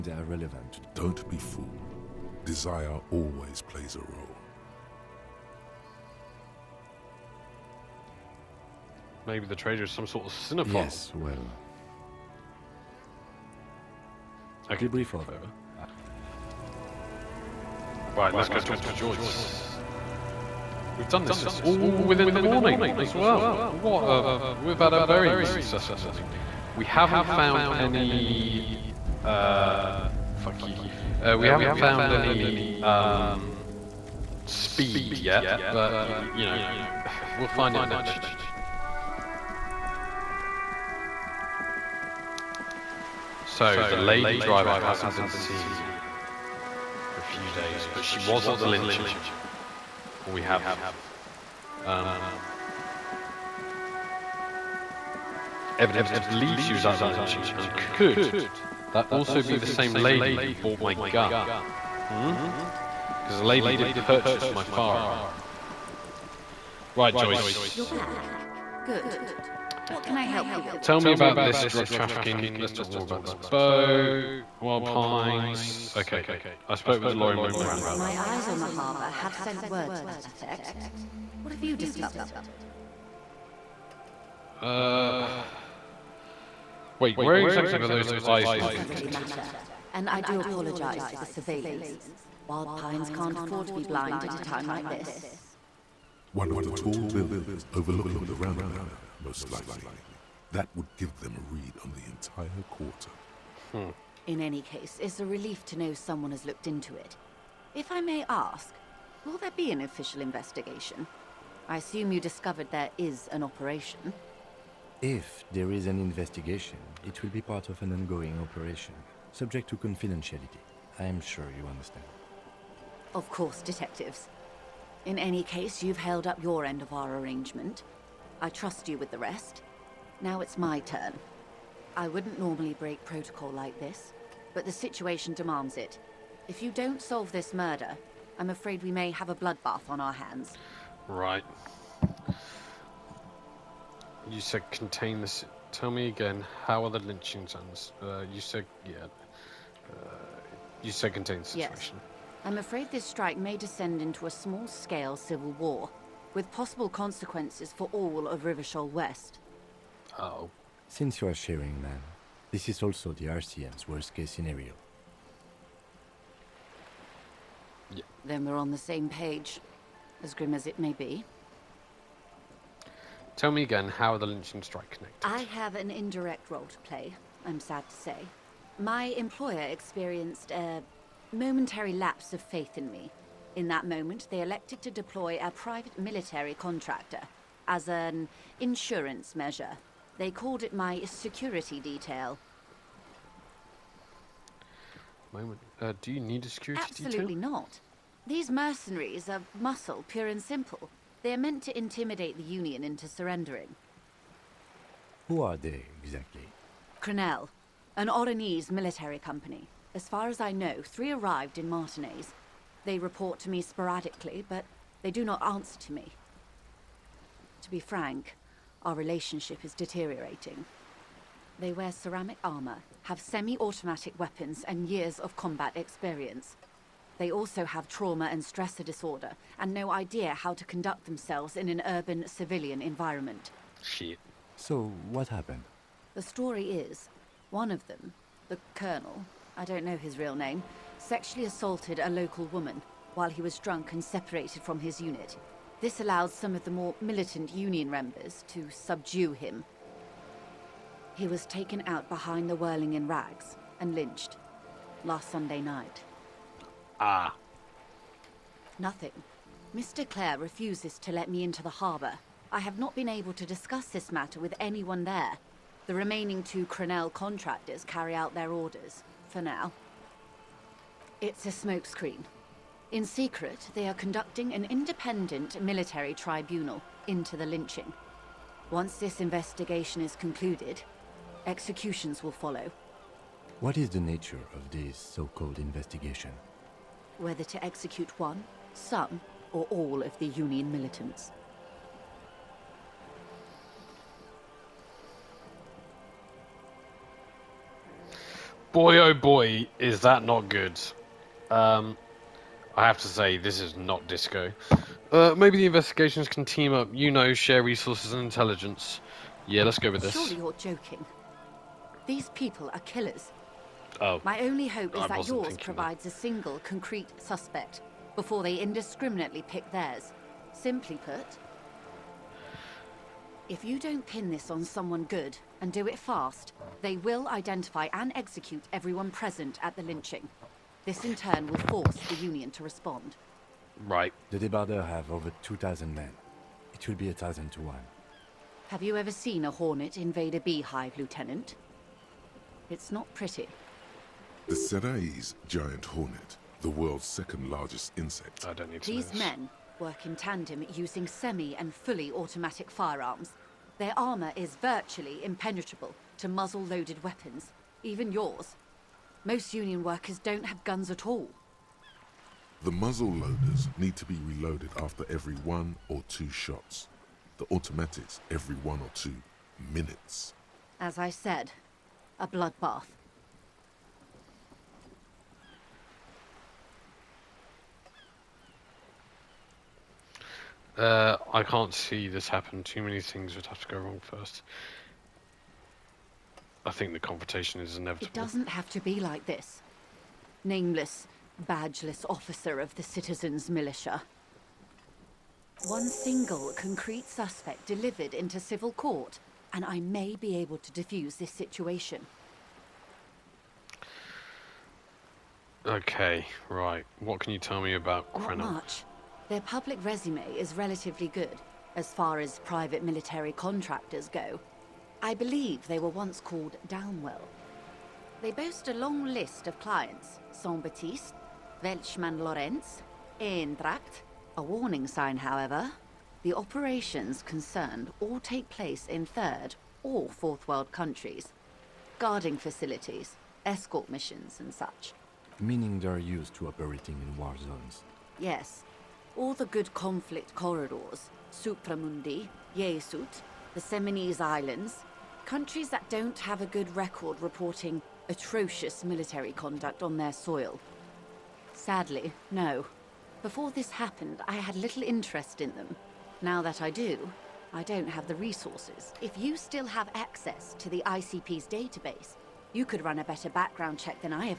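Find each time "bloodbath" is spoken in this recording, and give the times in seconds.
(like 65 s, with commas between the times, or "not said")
139 s, 372 s.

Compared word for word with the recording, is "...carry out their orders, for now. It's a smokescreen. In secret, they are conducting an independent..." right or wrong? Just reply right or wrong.
right.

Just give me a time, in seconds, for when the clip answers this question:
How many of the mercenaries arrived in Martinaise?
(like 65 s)
210 s.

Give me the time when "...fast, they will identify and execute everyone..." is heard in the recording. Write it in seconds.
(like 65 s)
325 s.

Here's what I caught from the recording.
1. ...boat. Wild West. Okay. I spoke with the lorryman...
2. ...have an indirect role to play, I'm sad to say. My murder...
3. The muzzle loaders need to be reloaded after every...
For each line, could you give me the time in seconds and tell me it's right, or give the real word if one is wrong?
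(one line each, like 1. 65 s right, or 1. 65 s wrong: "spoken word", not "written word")
1. 73 s wrong: "Pines", not "West"
2. 175 s wrong: "employer", not "murder"
3. 362 s right.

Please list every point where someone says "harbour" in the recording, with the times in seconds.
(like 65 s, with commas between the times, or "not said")
78 s, 261 s.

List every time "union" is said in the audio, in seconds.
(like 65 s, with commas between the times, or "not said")
202 s, 247 s, 290 s, 332 s, 359 s.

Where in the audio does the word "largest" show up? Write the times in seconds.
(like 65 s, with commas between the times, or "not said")
347 s.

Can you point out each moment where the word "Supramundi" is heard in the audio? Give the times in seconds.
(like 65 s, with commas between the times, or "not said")
441 s.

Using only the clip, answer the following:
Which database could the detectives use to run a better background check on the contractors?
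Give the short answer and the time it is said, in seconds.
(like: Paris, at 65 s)
ICP's database, at 460 s.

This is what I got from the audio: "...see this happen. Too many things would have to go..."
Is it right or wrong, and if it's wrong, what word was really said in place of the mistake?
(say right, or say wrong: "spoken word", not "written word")
right.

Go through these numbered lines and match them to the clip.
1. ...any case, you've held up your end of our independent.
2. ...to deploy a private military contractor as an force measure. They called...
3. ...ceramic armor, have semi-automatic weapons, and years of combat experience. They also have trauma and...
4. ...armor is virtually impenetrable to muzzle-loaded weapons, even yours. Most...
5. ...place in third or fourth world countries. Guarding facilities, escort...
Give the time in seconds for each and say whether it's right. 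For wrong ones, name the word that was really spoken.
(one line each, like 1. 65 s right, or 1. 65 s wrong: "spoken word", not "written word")
1. 125 s wrong: "arrangement", not "independent"
2. 184 s wrong: "insurance", not "force"
3. 221 s right
4. 353 s right
5. 428 s right.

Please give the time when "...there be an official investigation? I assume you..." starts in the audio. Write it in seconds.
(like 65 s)
109 s.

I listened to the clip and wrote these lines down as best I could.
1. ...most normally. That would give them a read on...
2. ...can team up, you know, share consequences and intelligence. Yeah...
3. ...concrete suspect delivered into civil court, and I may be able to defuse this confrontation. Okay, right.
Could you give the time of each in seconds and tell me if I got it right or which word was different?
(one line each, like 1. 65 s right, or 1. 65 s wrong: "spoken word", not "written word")
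1. 99 s wrong: "likely", not "normally"
2. 306 s wrong: "resources", not "consequences"
3. 396 s wrong: "situation", not "confrontation".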